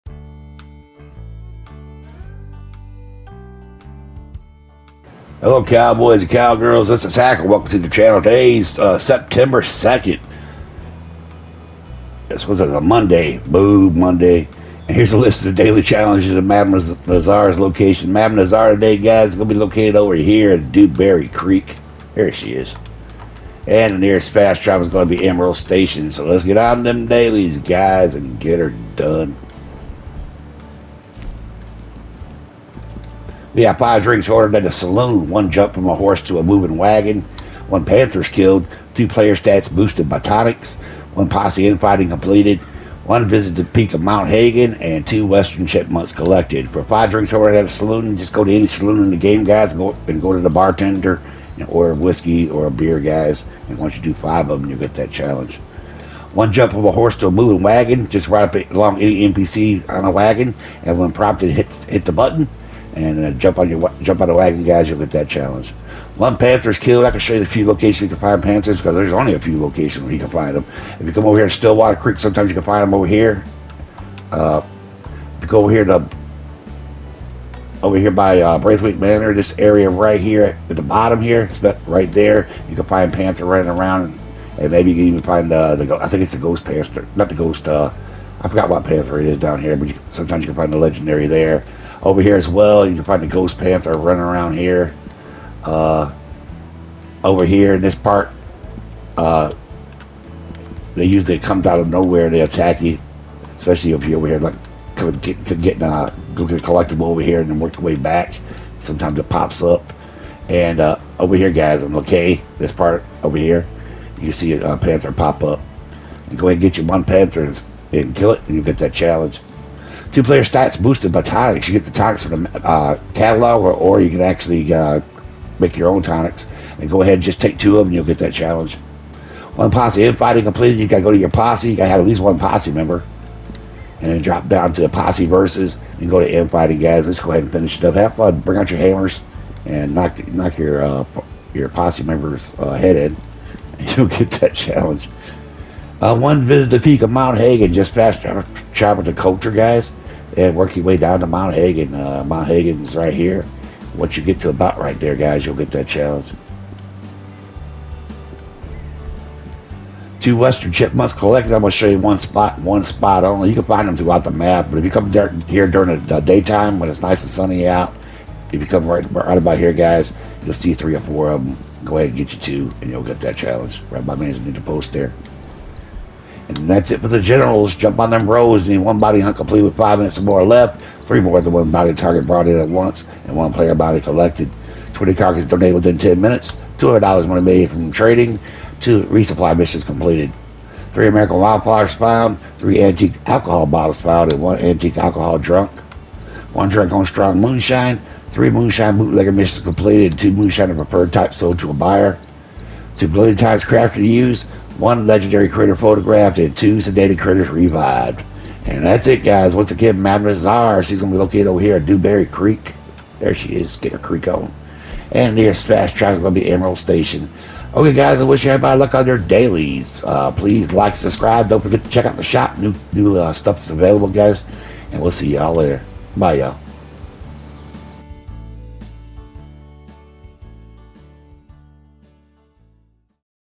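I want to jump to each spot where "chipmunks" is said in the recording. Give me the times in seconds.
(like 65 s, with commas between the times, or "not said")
45 s, 160 s.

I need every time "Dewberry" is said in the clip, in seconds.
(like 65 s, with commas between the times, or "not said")
20 s, 211 s.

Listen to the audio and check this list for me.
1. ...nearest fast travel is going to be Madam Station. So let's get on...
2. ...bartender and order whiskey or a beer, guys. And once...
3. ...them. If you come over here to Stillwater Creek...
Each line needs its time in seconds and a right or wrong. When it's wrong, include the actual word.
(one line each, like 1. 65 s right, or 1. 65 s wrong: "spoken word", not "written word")
1. 23 s wrong: "Emerald", not "Madam"
2. 50 s right
3. 70 s right.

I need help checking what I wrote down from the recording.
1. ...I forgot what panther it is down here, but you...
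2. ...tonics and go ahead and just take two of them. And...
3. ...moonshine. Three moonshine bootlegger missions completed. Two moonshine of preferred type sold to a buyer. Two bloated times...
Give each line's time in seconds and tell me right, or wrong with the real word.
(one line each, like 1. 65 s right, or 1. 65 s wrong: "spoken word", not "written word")
1. 88 s right
2. 126 s right
3. 197 s right.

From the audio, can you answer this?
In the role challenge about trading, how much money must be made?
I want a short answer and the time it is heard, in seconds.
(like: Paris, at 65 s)
$200, at 186 s.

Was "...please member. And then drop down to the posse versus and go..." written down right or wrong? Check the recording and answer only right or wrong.
wrong.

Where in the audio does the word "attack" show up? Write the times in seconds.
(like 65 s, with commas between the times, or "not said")
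102 s.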